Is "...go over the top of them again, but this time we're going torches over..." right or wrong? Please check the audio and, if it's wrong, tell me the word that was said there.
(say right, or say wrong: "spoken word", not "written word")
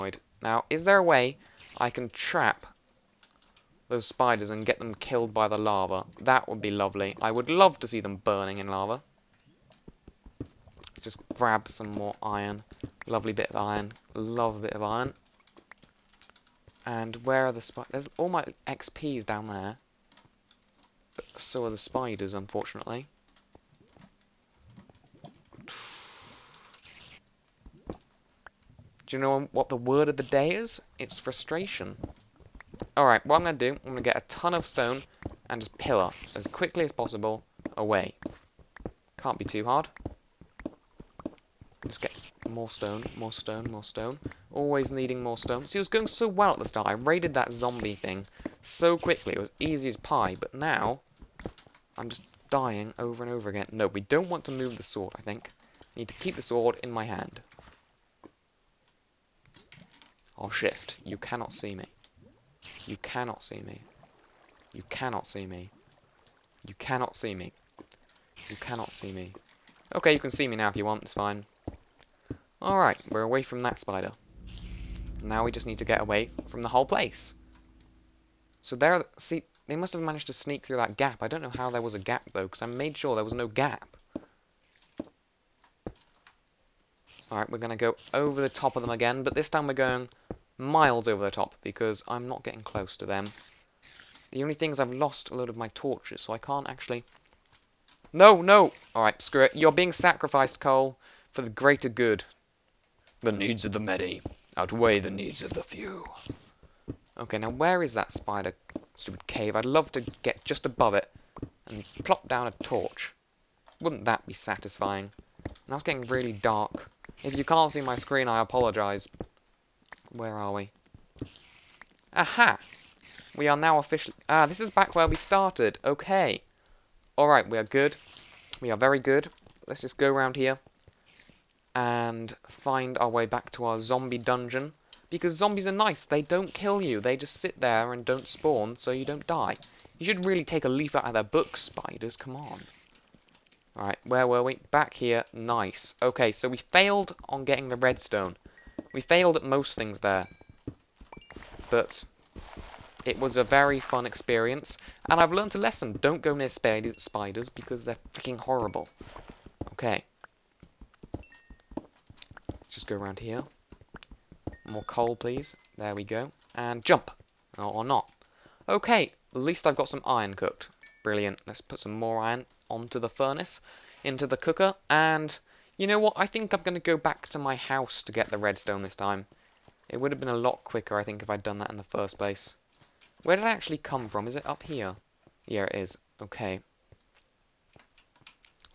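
wrong: "miles", not "torches".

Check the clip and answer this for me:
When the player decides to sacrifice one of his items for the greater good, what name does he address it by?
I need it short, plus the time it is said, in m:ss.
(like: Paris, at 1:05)
Cole, at 1:40.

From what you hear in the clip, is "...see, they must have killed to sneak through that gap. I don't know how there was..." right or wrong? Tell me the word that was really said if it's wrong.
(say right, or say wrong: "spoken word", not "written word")
wrong: "managed", not "killed".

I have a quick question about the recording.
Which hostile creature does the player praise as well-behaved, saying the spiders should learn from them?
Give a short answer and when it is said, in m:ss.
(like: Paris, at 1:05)
Zombies, at 2:15.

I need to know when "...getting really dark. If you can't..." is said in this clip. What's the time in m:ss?
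1:55.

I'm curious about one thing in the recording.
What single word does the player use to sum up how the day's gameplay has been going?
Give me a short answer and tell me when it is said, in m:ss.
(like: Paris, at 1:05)
Frustration, at 0:31.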